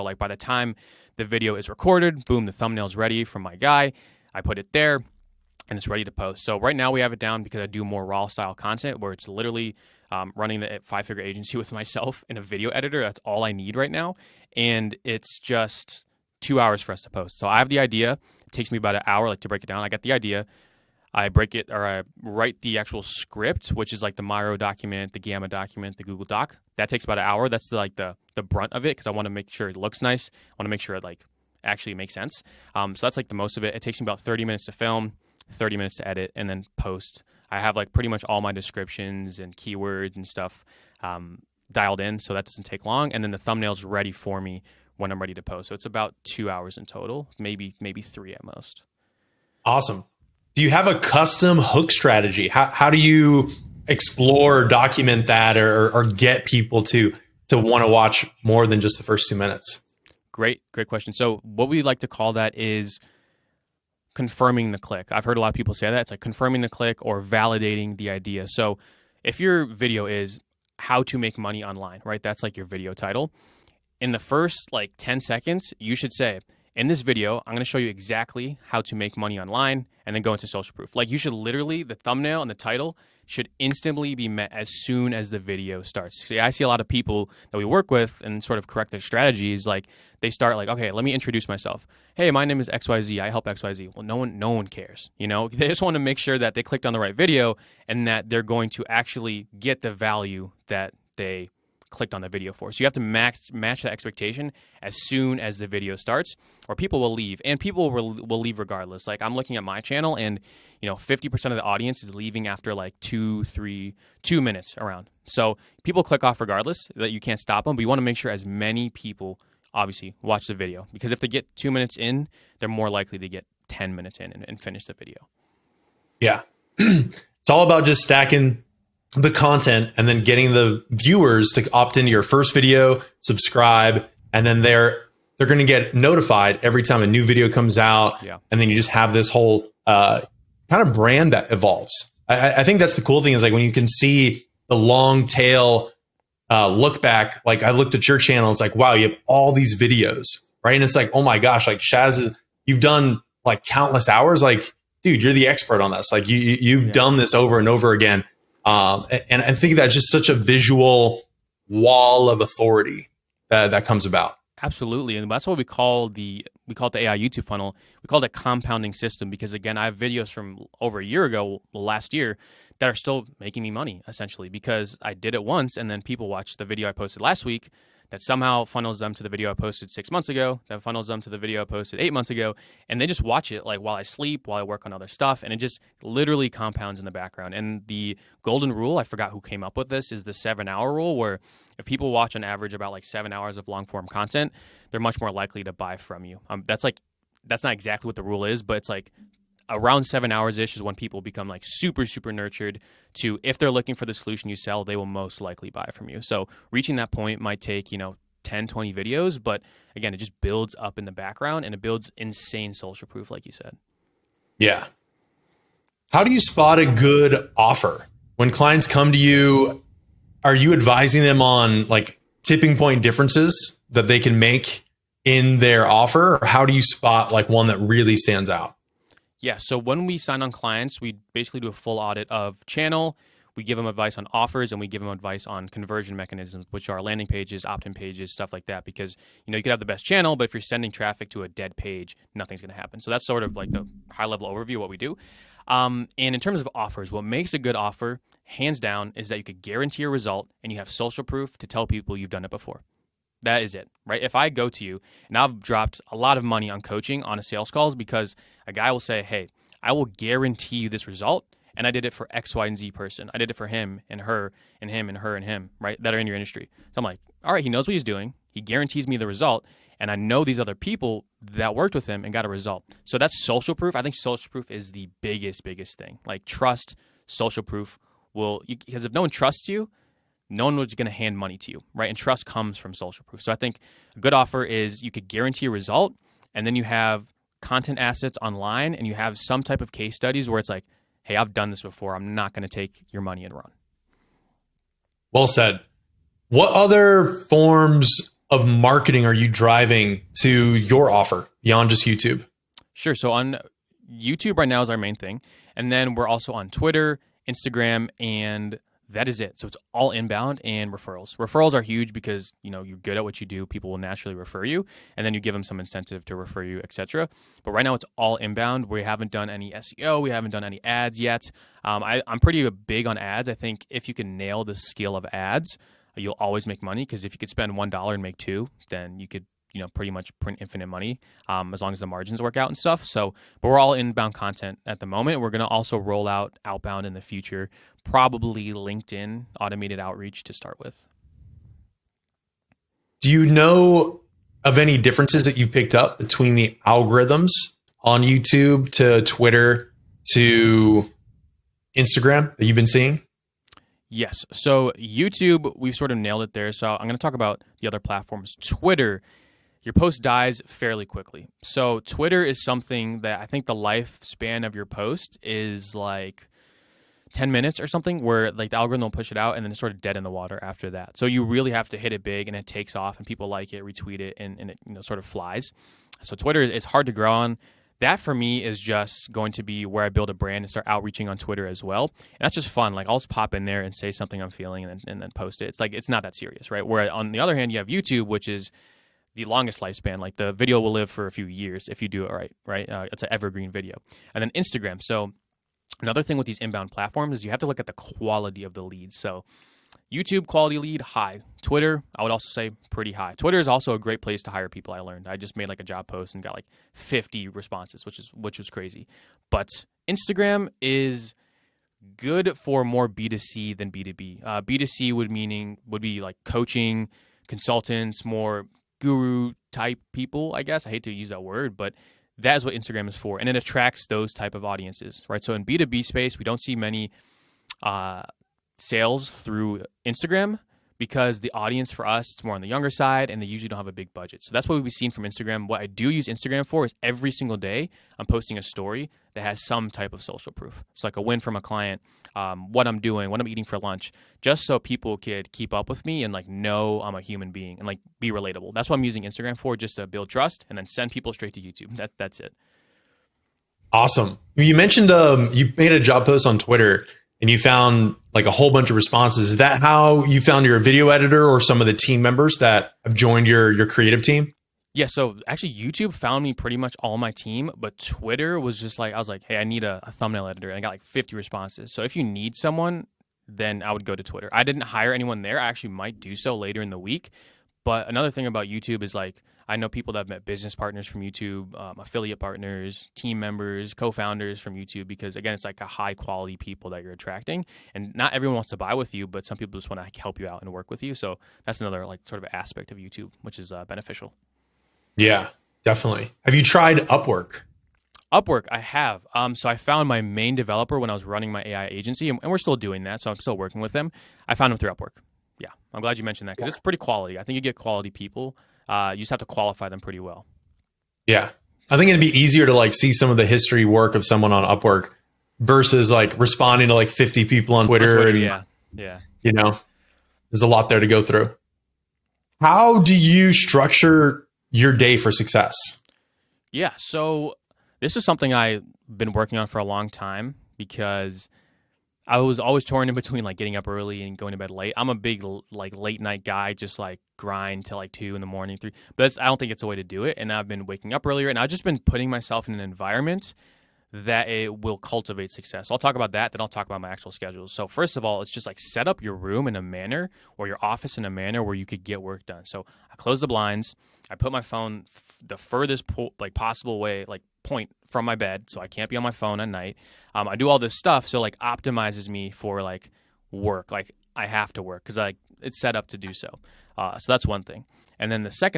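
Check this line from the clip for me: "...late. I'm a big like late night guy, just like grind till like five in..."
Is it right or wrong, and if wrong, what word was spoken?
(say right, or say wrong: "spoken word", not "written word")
wrong: "two", not "five".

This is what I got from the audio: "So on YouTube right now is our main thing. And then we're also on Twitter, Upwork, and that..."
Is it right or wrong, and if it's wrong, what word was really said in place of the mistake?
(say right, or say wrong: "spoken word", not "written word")
wrong: "Instagram", not "Upwork".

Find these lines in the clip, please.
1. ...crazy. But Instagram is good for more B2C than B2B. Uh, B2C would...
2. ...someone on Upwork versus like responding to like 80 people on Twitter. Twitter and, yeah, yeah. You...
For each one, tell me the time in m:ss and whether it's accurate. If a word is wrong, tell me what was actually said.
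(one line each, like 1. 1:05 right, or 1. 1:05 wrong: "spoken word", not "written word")
1. 6:48 right
2. 8:34 wrong: "50", not "80".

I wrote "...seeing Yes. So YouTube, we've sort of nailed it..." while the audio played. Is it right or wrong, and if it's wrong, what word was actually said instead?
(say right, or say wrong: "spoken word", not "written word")
right.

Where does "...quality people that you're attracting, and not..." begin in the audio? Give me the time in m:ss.
8:06.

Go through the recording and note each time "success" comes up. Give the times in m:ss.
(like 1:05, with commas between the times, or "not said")
8:45, 9:05.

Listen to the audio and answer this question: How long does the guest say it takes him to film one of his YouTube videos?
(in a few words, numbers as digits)
30 minutes.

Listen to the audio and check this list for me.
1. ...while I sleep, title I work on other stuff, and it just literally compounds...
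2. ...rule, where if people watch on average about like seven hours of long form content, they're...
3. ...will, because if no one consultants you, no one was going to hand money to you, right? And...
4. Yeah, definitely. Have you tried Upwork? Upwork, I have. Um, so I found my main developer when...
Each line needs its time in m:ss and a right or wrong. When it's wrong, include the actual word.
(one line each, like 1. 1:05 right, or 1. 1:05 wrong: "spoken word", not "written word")
1. 3:03 wrong: "while", not "title"
2. 3:10 right
3. 4:38 wrong: "trusts", not "consultants"
4. 8:15 right.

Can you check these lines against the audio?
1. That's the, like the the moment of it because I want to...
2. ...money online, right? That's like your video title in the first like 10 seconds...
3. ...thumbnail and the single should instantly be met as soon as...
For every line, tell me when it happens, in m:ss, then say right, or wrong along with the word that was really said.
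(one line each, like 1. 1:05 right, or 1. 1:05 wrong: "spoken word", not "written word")
1. 0:27 wrong: "brunt", not "moment"
2. 1:11 right
3. 1:21 wrong: "title", not "single".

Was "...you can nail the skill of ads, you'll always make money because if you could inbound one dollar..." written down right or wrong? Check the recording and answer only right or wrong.
wrong.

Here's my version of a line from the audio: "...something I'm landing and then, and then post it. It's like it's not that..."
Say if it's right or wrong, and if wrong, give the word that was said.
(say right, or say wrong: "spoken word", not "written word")
wrong: "feeling", not "landing".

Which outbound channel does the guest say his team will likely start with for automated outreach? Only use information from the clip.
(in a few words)
LinkedIn.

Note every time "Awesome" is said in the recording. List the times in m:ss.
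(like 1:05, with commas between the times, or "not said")
0:49, 7:33.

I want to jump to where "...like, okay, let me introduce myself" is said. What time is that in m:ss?
1:30.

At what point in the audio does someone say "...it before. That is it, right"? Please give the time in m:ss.
4:12.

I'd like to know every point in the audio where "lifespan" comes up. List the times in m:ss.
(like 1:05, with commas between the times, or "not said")
6:03, 6:29.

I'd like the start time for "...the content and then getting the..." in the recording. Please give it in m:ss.
2:09.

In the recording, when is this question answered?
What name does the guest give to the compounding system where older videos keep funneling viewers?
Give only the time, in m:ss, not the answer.
2:47.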